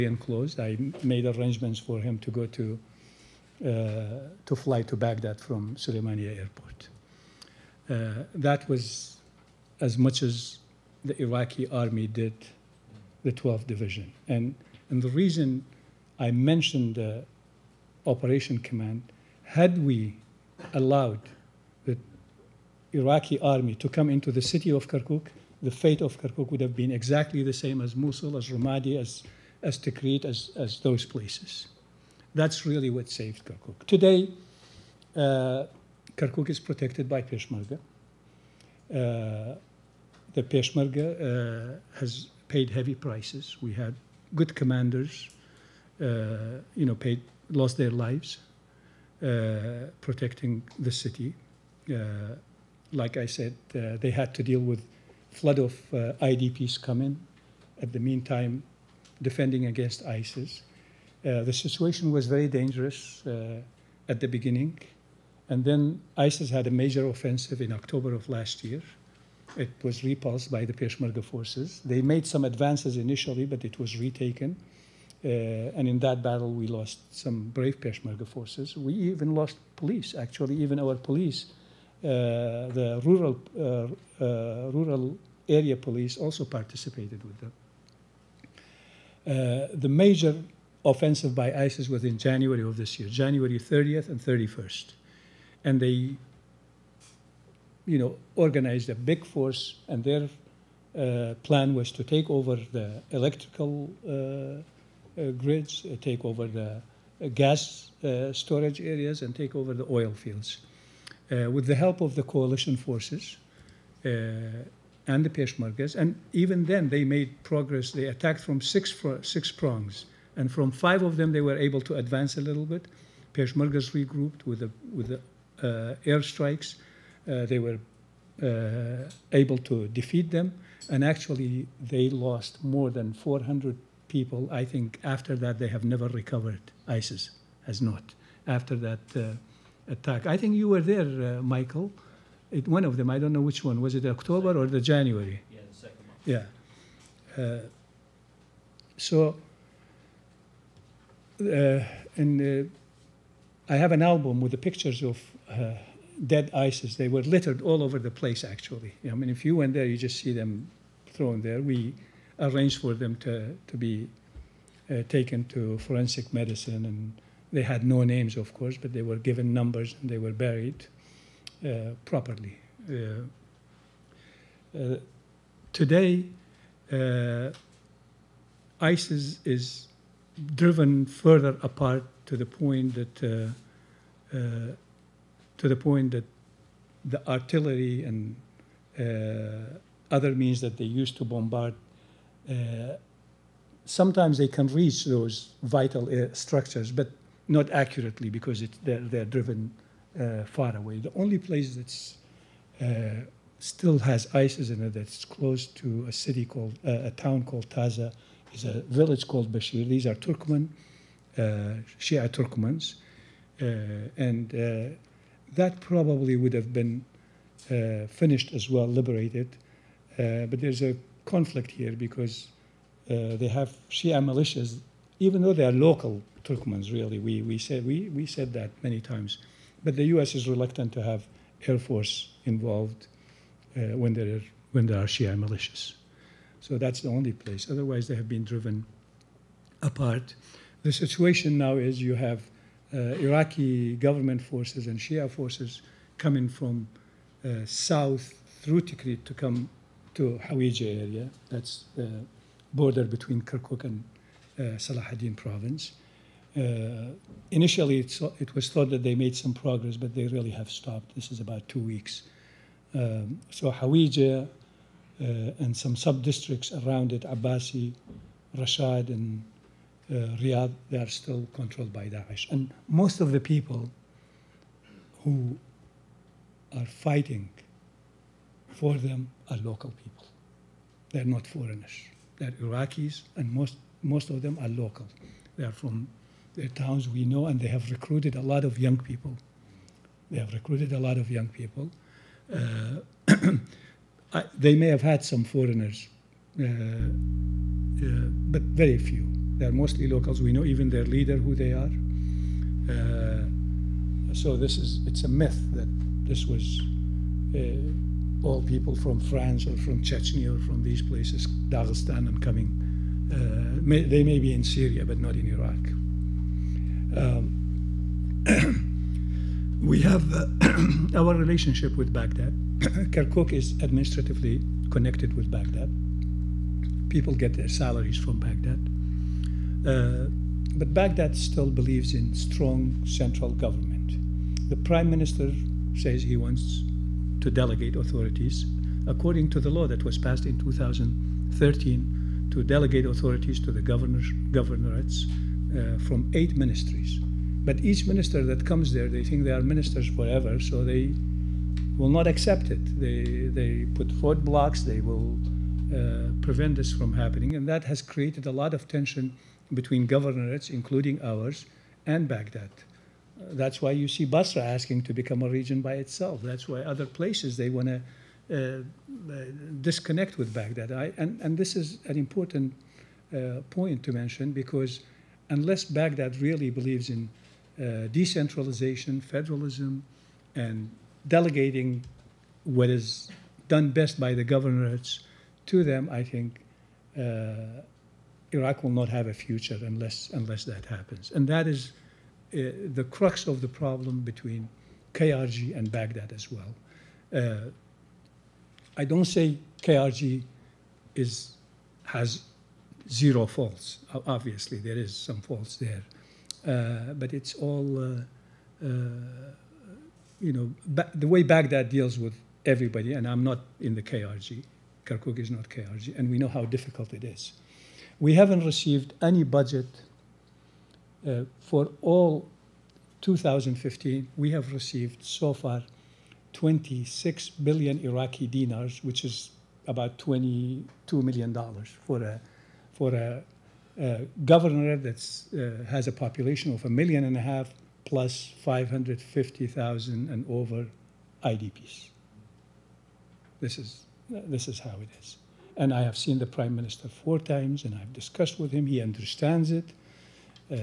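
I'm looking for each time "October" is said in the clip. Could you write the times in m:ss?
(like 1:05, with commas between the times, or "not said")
1:07, 2:24.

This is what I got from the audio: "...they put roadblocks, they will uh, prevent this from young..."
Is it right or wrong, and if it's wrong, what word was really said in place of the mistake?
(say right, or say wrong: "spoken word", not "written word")
wrong: "happening", not "young".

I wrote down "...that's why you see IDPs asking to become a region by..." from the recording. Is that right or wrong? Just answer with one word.
wrong.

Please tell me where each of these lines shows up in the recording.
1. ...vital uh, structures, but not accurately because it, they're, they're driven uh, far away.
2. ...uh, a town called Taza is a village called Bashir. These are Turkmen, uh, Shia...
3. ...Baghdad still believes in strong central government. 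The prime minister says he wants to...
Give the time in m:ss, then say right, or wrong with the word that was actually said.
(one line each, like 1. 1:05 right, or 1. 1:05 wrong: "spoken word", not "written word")
1. 3:15 right
2. 3:26 right
3. 5:30 right.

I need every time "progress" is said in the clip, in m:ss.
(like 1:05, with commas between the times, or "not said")
1:57, 4:19.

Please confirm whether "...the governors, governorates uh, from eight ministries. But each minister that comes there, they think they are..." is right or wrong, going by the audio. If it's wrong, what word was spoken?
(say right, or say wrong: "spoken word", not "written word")
right.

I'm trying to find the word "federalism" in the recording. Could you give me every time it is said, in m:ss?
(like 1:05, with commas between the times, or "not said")
6:19.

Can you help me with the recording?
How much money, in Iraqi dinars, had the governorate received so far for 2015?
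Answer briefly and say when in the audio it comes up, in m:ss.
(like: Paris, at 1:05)
26 billion Iraqi dinars, at 7:06.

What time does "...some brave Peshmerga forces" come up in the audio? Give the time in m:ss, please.
1:17.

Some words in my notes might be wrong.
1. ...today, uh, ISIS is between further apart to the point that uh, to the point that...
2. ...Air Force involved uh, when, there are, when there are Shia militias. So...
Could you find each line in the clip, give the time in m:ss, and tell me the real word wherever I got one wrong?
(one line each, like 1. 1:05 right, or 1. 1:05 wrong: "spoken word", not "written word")
1. 2:55 wrong: "driven", not "between"
2. 3:51 right.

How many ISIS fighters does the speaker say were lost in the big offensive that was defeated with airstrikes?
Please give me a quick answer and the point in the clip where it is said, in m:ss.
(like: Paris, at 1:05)
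more than 400, at 2:12.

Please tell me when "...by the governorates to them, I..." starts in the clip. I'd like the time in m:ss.
6:24.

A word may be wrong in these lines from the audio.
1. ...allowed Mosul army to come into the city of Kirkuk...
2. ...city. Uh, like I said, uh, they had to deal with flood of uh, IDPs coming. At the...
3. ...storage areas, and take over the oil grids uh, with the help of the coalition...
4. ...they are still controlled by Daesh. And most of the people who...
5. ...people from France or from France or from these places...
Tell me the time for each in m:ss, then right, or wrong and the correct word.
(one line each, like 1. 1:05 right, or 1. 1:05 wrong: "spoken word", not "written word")
1. 0:20 wrong: "Iraqi", not "Mosul"
2. 0:50 right
3. 1:48 wrong: "fields", not "grids"
4. 4:30 right
5. 5:08 wrong: "Chechnya", not "France".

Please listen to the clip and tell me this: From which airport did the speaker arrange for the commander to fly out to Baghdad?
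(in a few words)
Suleimania Airport.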